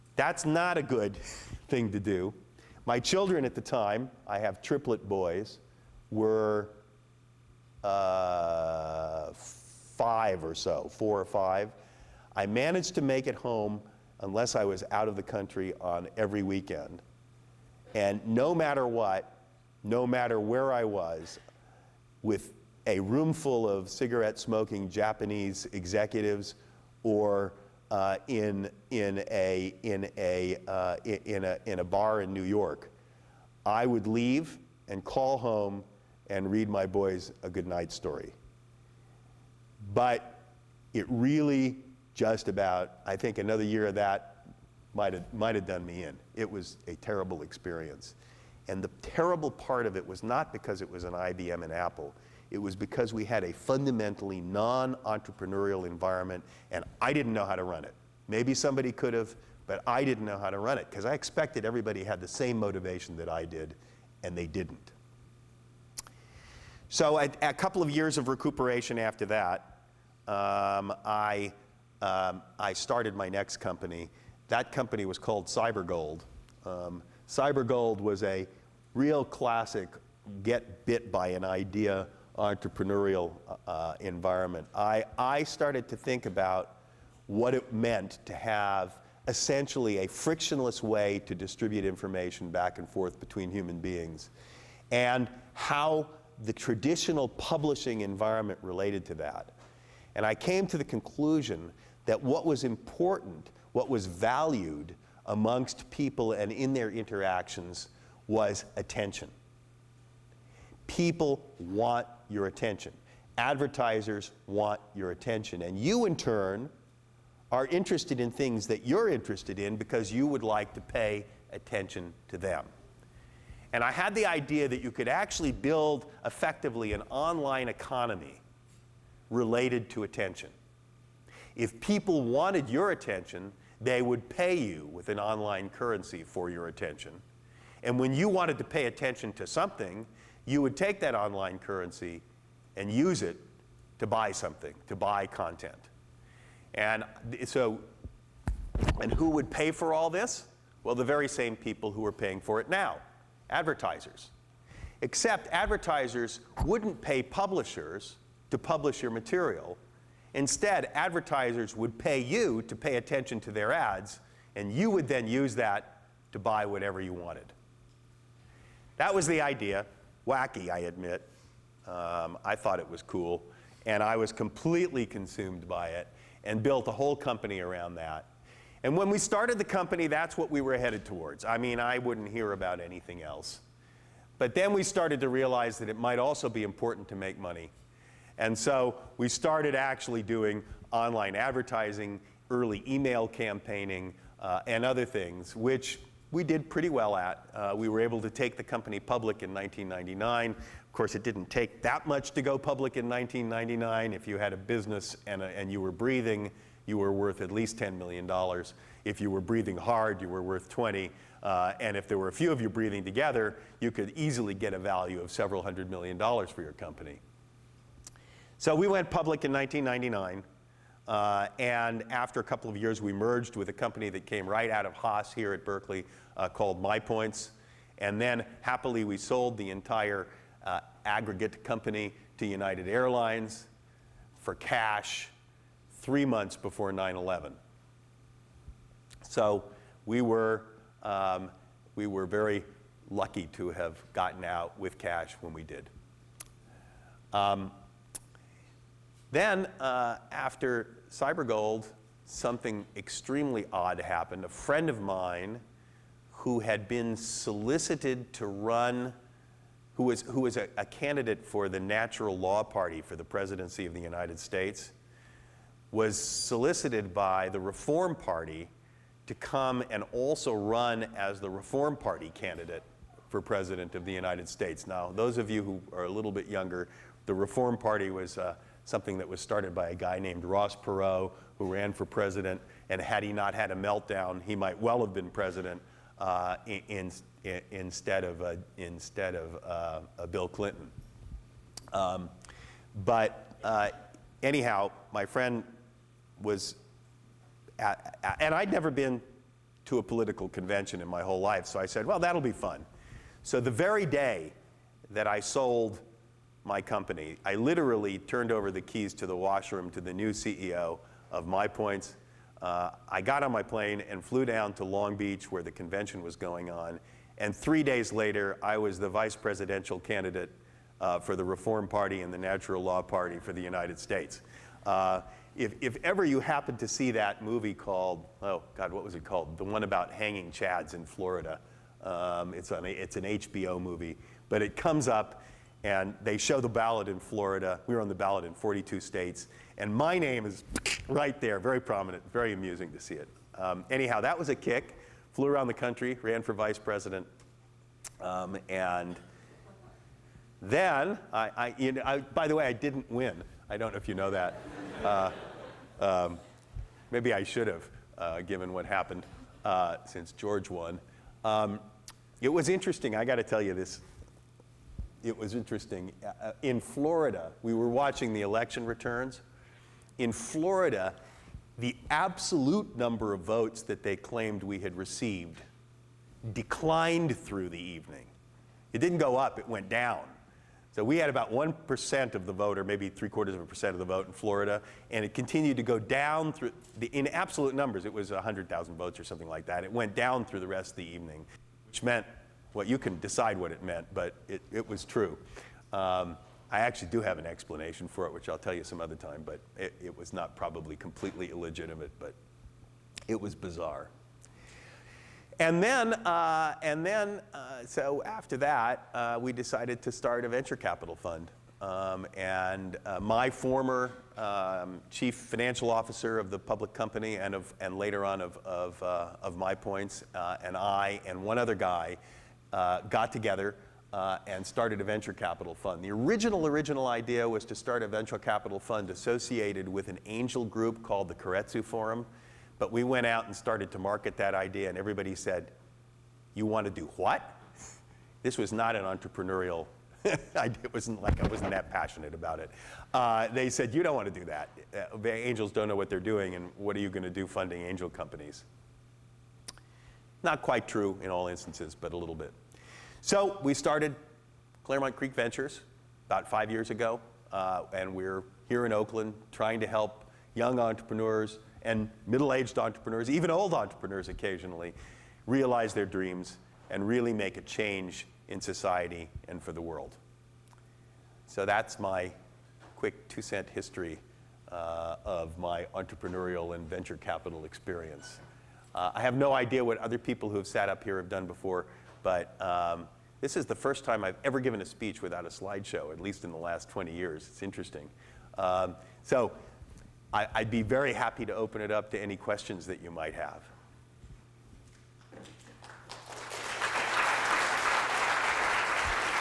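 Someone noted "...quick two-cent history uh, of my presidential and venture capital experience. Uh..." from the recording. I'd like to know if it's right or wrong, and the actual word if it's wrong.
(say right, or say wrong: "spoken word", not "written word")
wrong: "entrepreneurial", not "presidential".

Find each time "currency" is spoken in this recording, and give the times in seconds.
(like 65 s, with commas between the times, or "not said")
135 s, 141 s.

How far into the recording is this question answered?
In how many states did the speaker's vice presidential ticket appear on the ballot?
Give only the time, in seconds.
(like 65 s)
338 s.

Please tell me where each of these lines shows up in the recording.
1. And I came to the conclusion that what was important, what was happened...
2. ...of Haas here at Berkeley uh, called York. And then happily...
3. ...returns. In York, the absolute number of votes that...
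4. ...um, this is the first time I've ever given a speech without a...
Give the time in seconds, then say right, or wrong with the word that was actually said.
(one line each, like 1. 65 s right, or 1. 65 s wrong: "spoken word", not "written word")
1. 100 s wrong: "valued", not "happened"
2. 224 s wrong: "MyPoints", not "York"
3. 368 s wrong: "Florida", not "York"
4. 482 s right.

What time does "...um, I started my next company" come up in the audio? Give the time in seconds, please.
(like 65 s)
72 s.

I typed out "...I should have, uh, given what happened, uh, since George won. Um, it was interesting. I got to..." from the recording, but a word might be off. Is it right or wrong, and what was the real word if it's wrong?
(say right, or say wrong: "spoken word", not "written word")
right.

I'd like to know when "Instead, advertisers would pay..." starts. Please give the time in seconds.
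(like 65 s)
160 s.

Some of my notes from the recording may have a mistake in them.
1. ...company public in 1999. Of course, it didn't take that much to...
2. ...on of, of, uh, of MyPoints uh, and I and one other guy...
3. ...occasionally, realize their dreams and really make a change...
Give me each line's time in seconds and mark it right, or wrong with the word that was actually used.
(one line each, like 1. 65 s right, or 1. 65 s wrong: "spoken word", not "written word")
1. 198 s right
2. 418 s right
3. 464 s right.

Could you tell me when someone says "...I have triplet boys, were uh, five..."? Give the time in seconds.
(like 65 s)
4 s.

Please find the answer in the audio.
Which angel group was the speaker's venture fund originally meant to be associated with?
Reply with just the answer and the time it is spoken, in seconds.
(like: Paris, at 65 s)
Keiretsu Forum, at 431 s.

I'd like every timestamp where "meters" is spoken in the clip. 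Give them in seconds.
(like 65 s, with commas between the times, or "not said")
not said.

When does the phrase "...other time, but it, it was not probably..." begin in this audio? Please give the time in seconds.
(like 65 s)
399 s.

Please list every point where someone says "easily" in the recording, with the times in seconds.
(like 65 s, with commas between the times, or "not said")
214 s.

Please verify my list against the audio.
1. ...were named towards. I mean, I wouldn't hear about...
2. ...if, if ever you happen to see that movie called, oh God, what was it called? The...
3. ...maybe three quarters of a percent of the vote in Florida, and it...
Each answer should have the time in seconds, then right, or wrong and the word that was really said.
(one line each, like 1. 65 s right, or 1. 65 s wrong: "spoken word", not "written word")
1. 180 s wrong: "headed", not "named"
2. 325 s right
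3. 382 s right.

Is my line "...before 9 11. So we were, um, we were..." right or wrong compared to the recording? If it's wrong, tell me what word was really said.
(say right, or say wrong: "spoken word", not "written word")
right.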